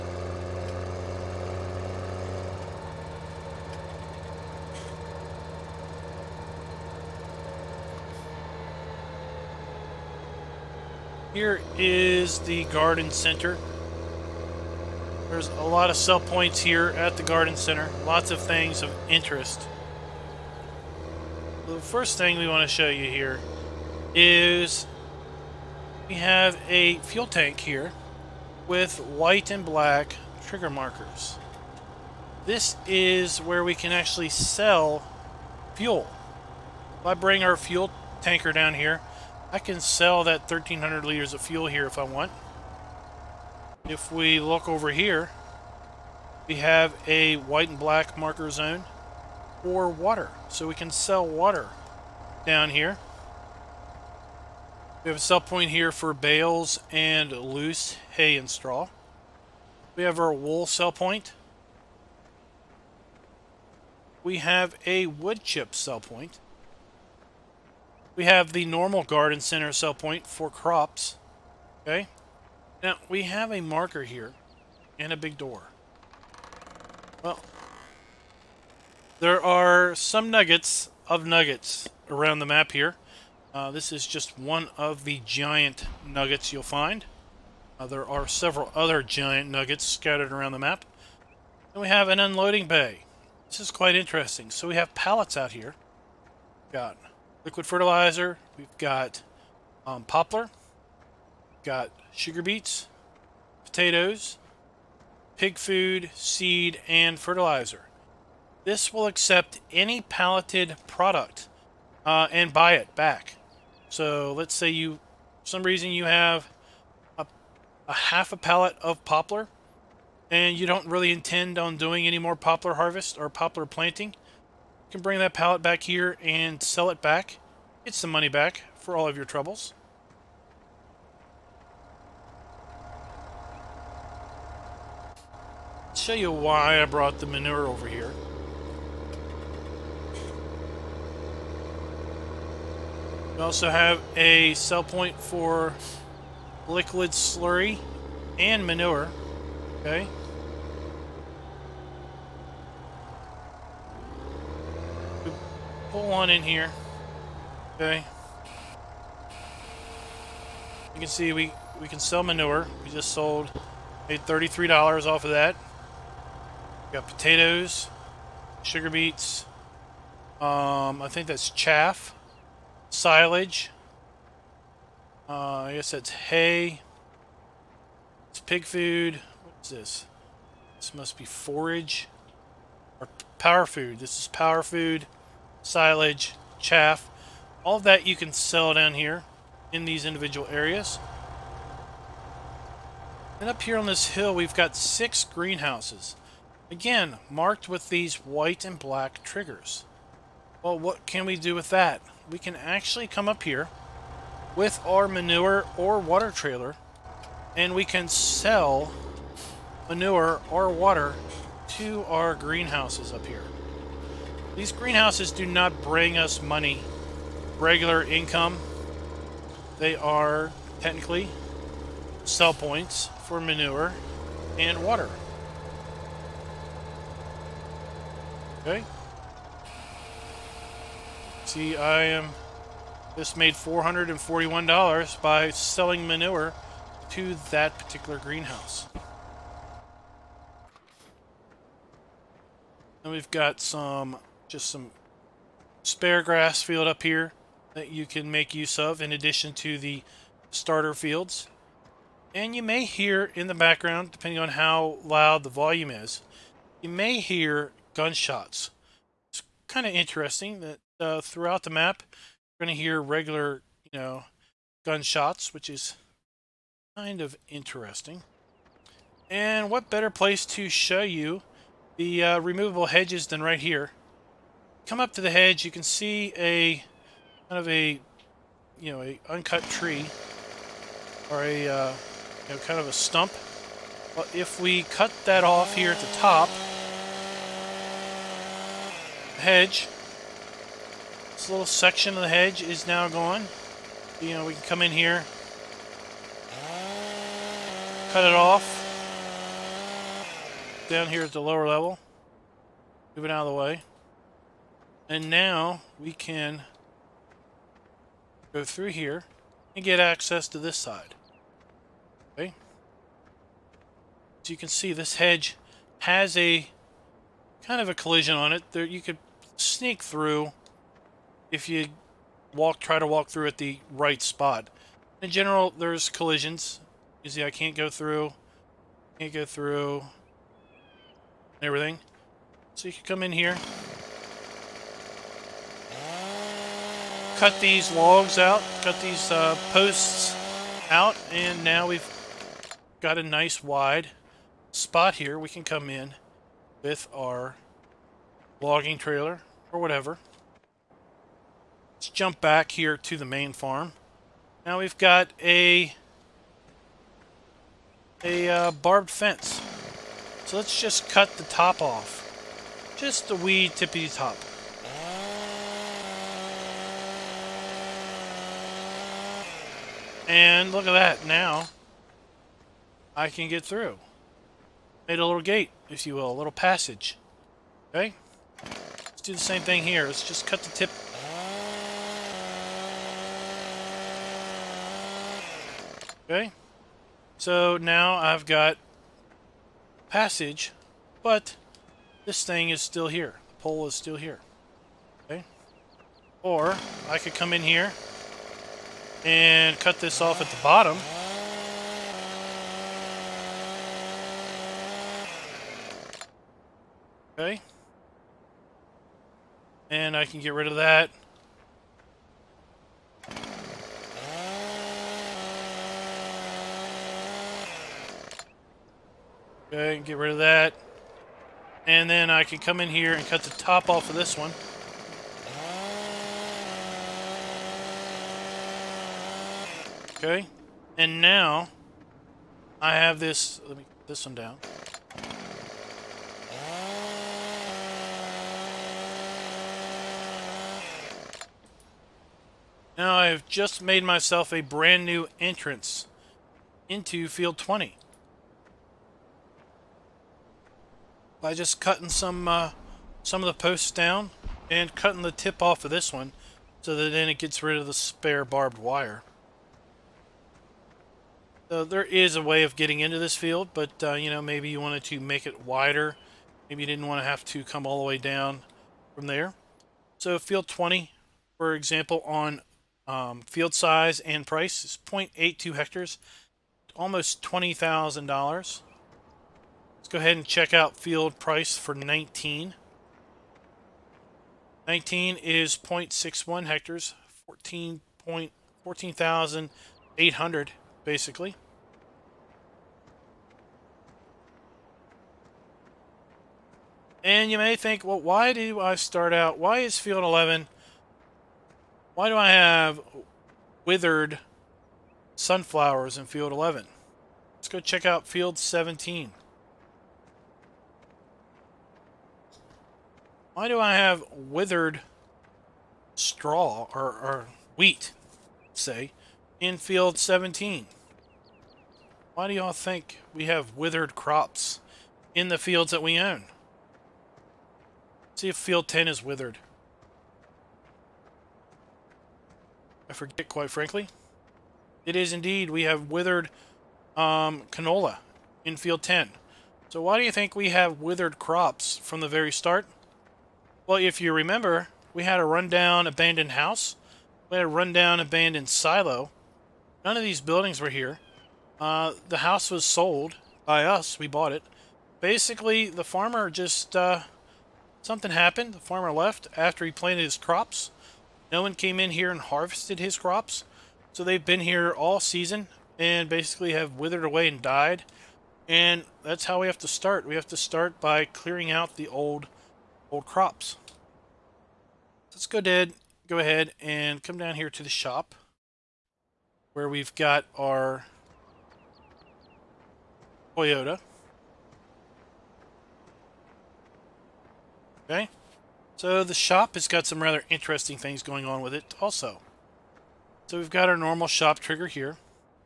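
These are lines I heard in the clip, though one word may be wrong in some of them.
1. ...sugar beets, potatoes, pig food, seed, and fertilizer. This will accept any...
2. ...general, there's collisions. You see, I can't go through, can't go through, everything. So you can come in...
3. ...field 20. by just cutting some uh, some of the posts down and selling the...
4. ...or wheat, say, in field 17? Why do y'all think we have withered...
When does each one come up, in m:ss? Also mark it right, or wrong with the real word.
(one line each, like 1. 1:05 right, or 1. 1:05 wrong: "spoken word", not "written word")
1. 1:42 right
2. 5:25 right
3. 7:27 wrong: "cutting", not "selling"
4. 8:37 right.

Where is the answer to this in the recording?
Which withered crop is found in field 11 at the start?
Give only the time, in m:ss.
8:25.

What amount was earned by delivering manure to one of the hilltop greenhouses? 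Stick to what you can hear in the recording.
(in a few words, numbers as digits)
$441.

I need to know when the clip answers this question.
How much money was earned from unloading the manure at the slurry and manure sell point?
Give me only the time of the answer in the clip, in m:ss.
2:44.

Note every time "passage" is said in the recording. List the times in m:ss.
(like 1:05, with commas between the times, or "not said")
6:16, 6:30.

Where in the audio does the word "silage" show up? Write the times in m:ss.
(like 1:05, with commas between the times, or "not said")
2:52, 3:05.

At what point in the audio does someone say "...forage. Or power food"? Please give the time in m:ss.
3:01.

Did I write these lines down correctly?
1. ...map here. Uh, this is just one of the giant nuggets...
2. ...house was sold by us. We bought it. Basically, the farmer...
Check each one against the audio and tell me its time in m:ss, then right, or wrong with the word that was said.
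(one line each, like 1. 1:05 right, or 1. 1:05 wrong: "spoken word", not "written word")
1. 1:22 right
2. 9:12 right.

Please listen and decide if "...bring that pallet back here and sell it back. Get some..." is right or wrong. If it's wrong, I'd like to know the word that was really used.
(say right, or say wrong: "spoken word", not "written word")
right.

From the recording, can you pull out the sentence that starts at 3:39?
They are technically sell points for manure and water.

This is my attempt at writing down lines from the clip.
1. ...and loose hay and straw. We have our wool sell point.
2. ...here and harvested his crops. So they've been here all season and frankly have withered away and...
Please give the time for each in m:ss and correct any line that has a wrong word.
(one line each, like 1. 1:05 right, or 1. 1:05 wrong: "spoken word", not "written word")
1. 0:56 right
2. 9:22 wrong: "basically", not "frankly".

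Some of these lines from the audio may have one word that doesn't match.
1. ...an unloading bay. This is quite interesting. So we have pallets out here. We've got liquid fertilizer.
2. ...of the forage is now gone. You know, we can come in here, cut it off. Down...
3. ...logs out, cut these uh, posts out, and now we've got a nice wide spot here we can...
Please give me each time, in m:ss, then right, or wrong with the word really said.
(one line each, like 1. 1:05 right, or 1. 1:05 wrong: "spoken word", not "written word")
1. 1:32 right
2. 4:52 wrong: "hedge", not "forage"
3. 5:37 right.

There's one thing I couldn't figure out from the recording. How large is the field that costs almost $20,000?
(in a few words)
0.82 hectares.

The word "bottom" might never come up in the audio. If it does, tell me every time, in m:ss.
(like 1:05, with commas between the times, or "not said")
6:40.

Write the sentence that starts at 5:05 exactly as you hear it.
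And now we can go through here and get access to this side.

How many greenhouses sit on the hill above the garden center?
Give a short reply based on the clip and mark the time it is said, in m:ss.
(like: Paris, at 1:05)
6, at 3:14.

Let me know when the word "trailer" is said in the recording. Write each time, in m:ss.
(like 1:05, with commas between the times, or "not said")
3:26, 5:48.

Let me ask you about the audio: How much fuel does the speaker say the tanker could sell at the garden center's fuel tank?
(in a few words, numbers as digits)
1,300 liters.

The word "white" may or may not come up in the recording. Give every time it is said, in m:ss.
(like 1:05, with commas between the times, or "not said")
0:29, 0:47, 3:18.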